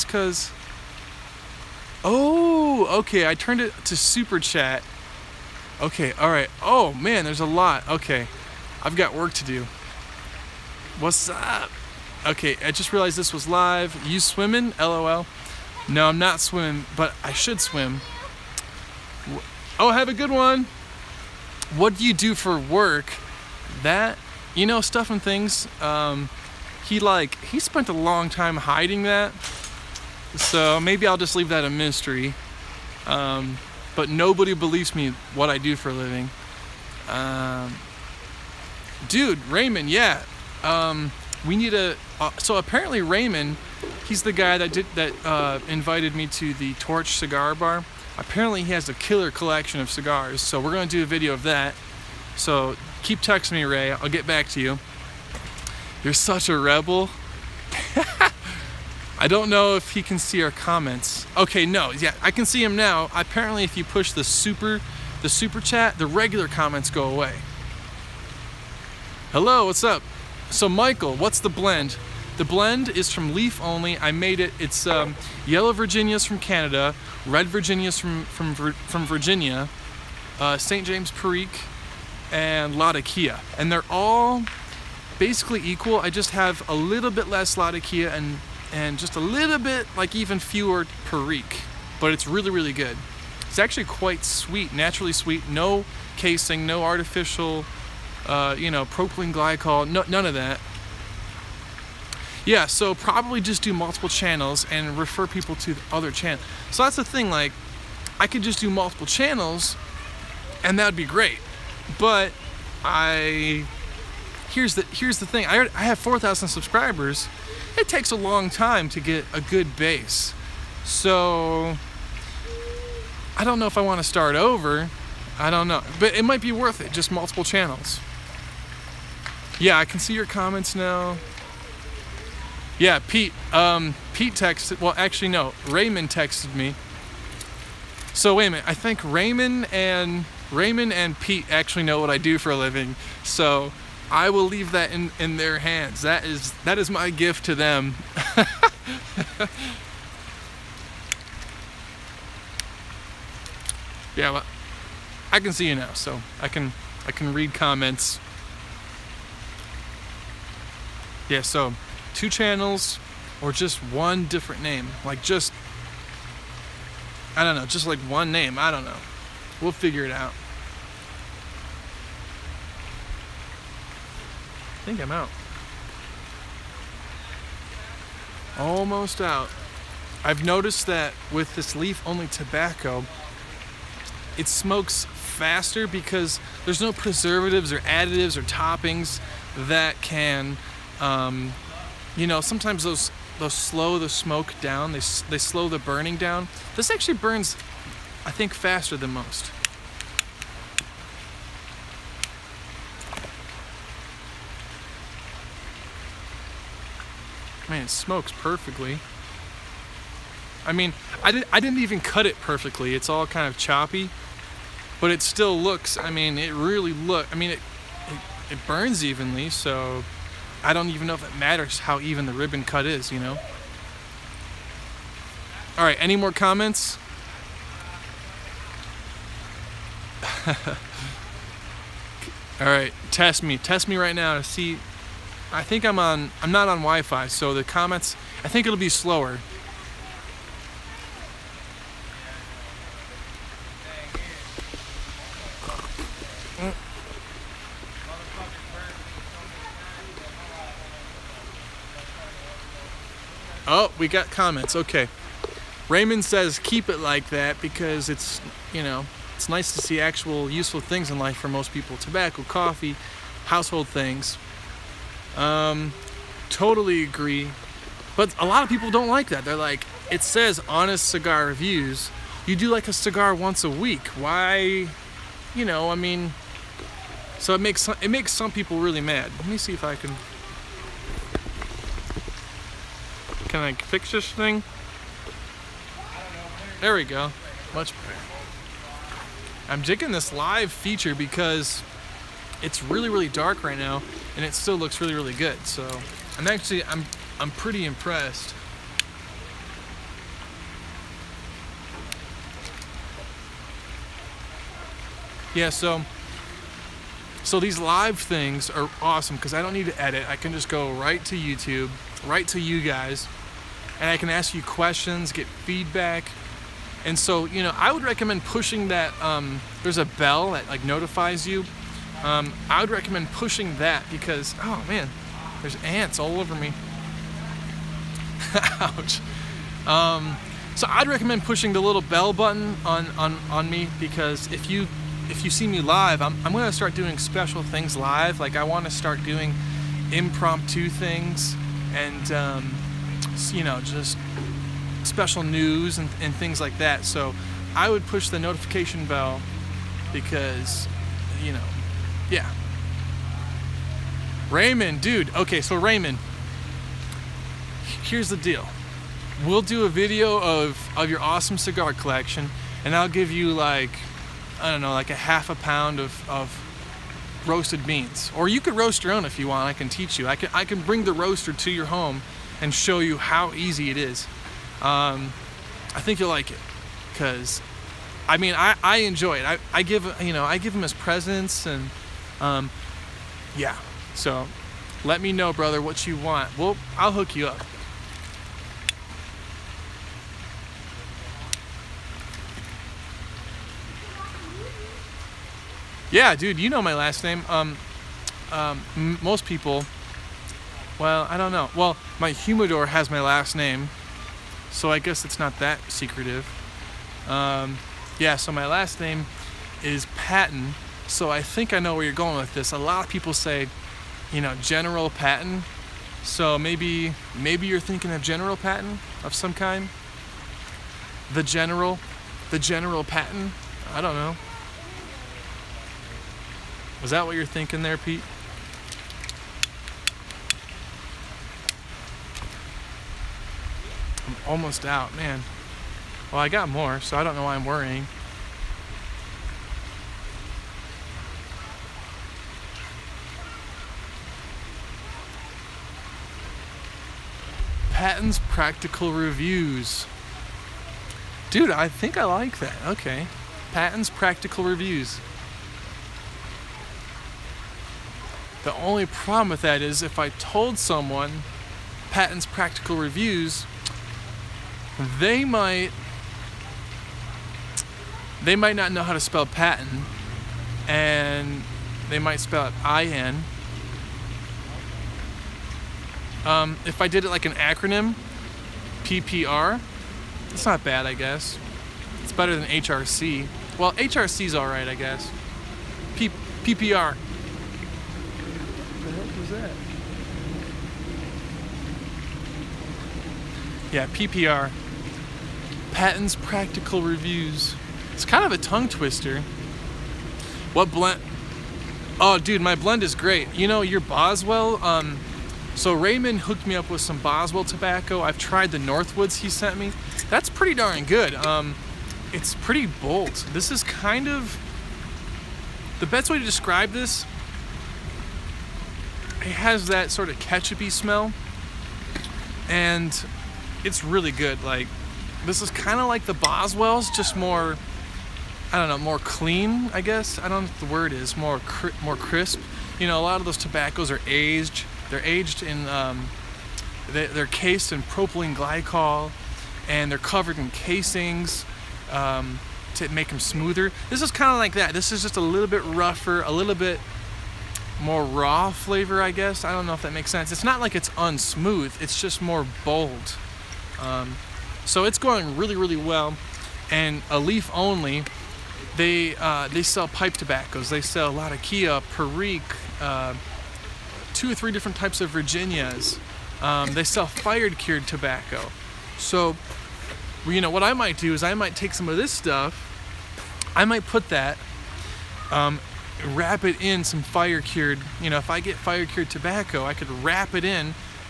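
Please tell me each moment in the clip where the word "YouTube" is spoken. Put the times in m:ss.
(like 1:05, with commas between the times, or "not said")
5:11.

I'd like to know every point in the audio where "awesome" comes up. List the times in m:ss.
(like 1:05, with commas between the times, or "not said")
5:08, 6:01.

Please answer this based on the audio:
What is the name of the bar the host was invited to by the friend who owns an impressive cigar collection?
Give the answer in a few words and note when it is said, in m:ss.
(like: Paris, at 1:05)
Torch Cigar Bar, at 0:46.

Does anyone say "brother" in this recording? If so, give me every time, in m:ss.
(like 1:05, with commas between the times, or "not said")
6:25.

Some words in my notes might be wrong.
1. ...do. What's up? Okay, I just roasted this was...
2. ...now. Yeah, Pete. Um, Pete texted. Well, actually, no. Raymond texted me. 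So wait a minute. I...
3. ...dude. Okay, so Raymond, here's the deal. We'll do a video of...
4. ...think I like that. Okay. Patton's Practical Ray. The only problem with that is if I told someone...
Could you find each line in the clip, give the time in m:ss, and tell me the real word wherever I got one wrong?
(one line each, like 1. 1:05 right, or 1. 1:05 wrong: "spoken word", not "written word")
1. 0:09 wrong: "realized", not "roasted"
2. 2:10 right
3. 5:55 right
4. 7:31 wrong: "Reviews", not "Ray".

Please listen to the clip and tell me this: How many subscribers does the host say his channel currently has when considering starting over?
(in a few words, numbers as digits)
4,000.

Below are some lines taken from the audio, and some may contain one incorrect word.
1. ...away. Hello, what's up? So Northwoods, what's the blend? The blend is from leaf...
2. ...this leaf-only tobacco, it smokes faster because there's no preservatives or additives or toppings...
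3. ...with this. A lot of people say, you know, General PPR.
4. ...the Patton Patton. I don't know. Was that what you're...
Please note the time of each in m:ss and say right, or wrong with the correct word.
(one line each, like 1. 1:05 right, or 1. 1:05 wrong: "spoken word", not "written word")
1. 1:07 wrong: "Michael", not "Northwoods"
2. 3:01 right
3. 6:52 wrong: "Patton", not "PPR"
4. 7:02 wrong: "General", not "Patton".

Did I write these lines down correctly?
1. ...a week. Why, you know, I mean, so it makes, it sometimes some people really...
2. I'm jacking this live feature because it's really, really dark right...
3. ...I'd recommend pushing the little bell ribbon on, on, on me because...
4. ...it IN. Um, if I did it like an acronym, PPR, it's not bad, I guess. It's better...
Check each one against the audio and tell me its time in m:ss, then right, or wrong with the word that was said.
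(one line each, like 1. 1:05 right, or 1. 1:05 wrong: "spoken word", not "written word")
1. 4:33 wrong: "makes", not "sometimes"
2. 4:49 right
3. 5:30 wrong: "button", not "ribbon"
4. 7:52 right.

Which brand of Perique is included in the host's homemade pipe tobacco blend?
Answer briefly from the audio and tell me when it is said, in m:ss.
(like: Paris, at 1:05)
St. James, at 1:20.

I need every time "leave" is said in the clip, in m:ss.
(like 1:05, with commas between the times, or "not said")
0:31, 2:24.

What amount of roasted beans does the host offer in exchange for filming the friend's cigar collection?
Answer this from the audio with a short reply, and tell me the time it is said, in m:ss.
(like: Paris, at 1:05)
half a pound, at 6:05.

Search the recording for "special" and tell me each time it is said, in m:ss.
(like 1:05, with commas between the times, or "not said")
5:37, 5:45.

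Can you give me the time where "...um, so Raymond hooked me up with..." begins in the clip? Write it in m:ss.
8:24.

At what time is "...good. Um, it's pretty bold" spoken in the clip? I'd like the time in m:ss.
8:31.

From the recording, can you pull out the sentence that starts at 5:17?
And so, you know, I would recommend pushing that.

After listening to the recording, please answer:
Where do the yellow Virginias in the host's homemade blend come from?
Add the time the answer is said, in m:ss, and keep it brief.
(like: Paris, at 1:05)
Canada, at 1:16.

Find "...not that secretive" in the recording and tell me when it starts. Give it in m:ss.
6:45.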